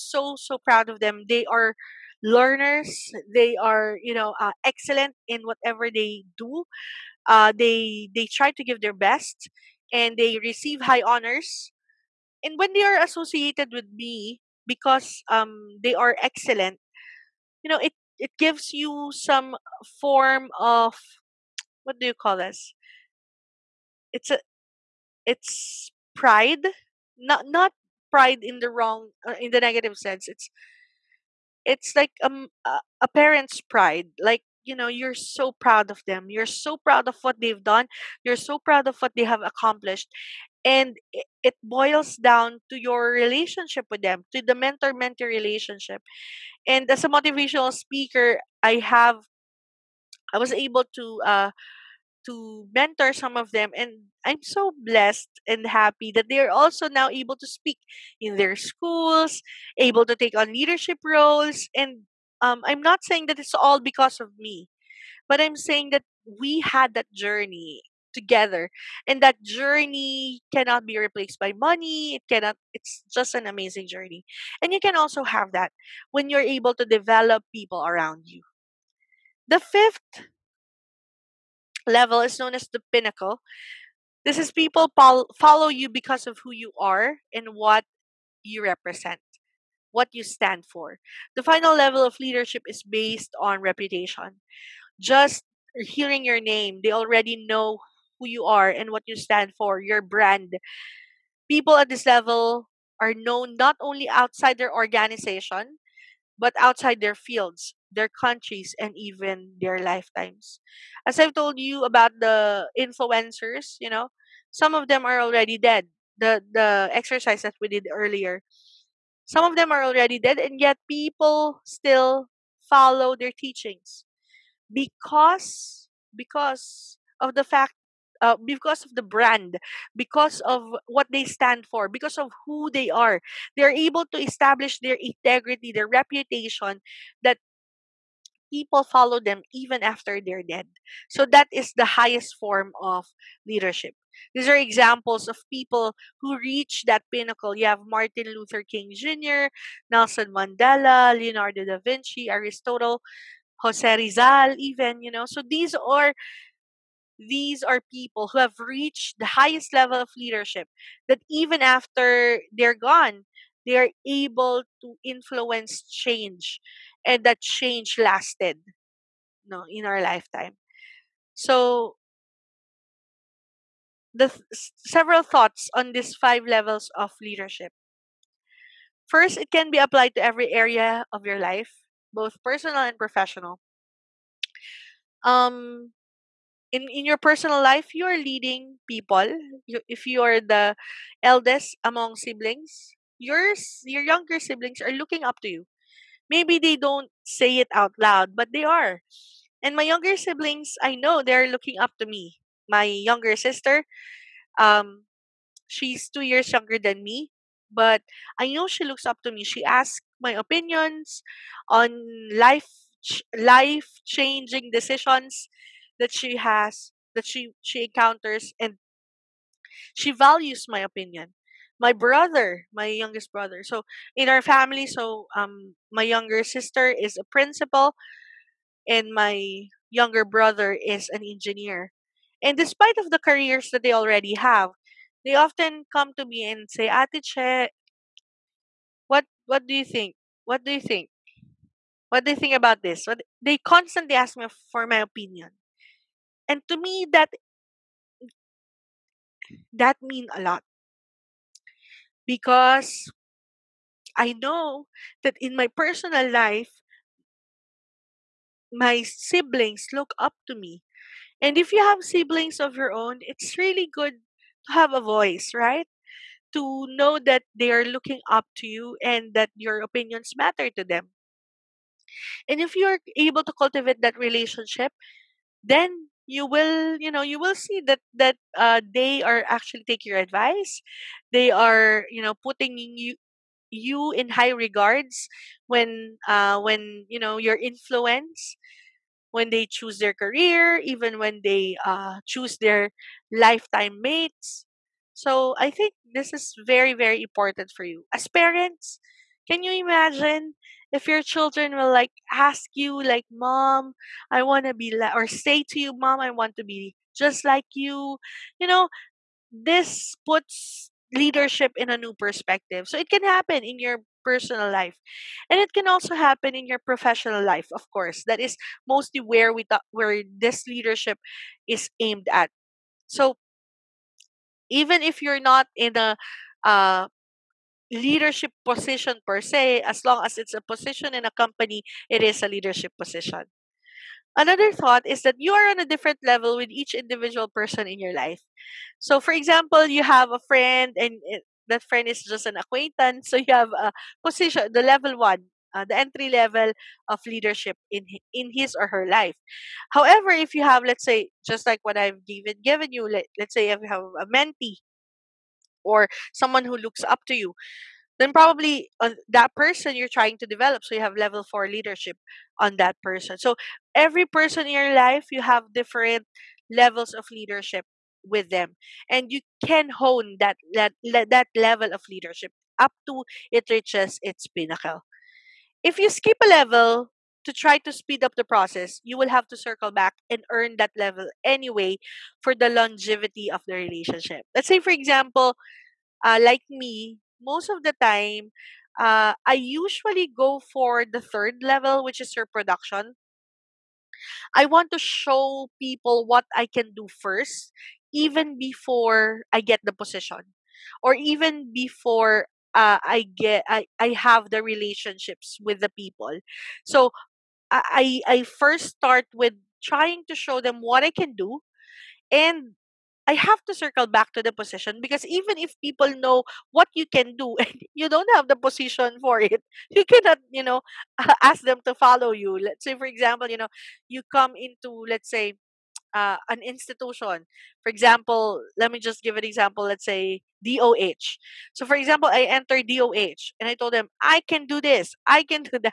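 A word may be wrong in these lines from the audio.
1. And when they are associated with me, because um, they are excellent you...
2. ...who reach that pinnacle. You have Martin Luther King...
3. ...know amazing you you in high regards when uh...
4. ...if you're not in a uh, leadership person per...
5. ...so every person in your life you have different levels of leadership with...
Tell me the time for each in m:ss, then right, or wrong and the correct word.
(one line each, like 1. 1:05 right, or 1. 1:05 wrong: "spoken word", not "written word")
1. 0:12 right
2. 2:26 right
3. 4:42 wrong: "putting", not "amazing"
4. 5:25 wrong: "position", not "person"
5. 6:03 right.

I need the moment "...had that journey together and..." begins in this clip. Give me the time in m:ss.
1:06.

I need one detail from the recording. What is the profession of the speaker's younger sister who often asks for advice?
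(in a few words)
Principal.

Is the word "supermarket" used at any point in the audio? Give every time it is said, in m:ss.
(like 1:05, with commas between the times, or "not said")
not said.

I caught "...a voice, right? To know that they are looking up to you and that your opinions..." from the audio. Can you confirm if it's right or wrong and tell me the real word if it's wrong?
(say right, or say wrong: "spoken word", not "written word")
right.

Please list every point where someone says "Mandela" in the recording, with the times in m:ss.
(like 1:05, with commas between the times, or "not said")
2:30.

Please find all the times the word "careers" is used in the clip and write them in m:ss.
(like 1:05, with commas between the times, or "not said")
3:53, 4:50.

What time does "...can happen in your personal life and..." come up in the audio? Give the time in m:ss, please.
5:13.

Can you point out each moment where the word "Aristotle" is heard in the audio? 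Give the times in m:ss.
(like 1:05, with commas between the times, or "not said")
2:32.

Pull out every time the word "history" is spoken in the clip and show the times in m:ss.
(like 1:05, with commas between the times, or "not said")
not said.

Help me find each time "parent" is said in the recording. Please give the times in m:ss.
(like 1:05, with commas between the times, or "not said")
0:33, 4:58.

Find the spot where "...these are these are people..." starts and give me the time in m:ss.
2:35.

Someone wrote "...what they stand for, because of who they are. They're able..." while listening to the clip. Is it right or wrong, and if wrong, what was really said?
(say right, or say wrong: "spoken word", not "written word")
right.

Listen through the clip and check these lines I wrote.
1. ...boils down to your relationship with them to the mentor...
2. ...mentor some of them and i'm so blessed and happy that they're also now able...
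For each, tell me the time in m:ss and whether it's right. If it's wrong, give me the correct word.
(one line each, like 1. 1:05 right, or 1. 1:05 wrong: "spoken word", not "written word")
1. 0:41 right
2. 0:52 right.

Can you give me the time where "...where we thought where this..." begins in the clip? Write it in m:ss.
5:19.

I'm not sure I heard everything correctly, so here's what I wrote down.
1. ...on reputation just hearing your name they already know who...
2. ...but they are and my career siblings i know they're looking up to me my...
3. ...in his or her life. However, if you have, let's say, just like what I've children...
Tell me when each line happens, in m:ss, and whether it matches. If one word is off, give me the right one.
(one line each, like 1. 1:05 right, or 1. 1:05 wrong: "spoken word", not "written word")
1. 1:33 right
2. 3:18 wrong: "younger", not "career"
3. 5:48 wrong: "given", not "children".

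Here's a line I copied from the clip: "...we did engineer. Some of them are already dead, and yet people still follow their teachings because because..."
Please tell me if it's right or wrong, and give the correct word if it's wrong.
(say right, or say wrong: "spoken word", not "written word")
wrong: "earlier", not "engineer".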